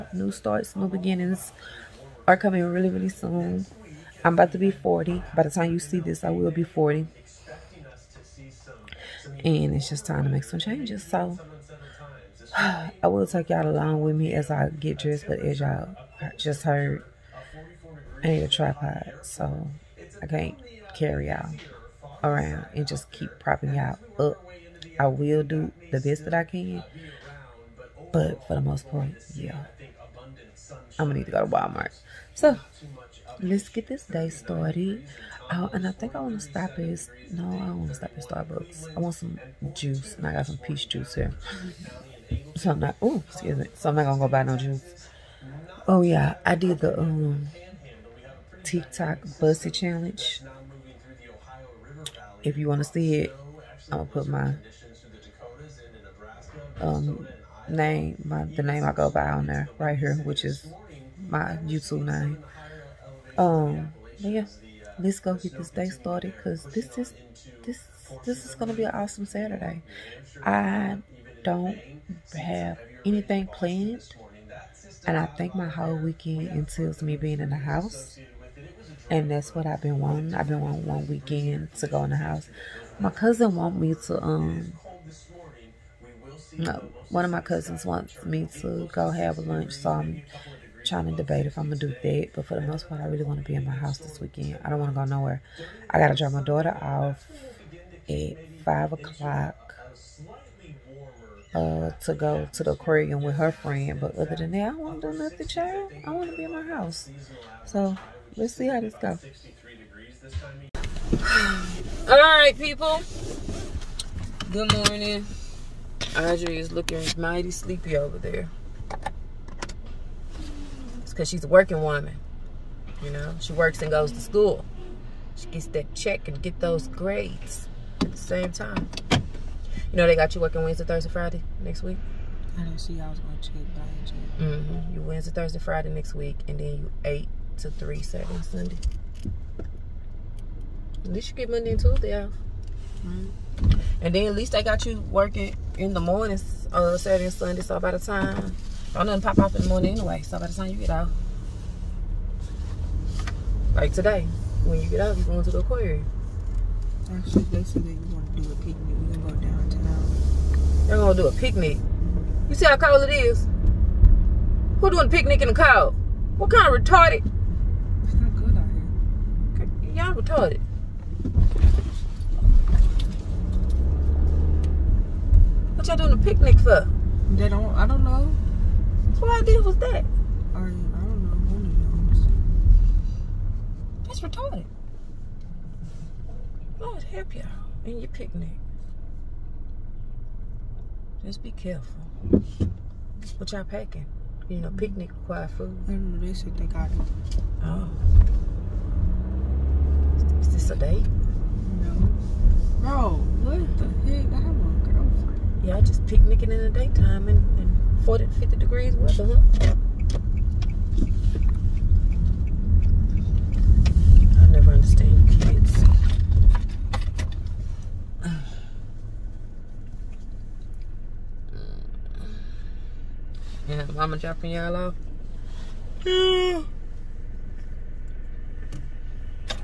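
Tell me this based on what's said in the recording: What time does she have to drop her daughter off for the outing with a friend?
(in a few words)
5:00.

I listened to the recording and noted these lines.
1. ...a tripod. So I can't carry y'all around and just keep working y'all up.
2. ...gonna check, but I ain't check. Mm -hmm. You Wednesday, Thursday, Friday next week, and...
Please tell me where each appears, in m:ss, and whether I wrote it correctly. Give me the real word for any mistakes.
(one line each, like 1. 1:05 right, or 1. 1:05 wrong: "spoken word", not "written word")
1. 0:18 wrong: "propping", not "working"
2. 2:13 right.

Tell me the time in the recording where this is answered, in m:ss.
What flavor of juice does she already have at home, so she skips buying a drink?
0:40.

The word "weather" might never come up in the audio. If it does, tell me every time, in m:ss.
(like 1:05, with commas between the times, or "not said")
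3:28.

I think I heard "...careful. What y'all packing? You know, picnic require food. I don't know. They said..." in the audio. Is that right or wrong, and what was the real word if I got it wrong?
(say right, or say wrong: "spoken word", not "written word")
right.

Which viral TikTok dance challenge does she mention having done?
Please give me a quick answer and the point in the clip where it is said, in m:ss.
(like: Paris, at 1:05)
Buss It Challenge, at 0:49.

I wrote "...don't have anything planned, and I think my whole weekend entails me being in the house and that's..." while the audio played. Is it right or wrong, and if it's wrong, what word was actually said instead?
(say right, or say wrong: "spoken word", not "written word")
right.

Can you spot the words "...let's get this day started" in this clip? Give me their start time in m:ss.
0:33.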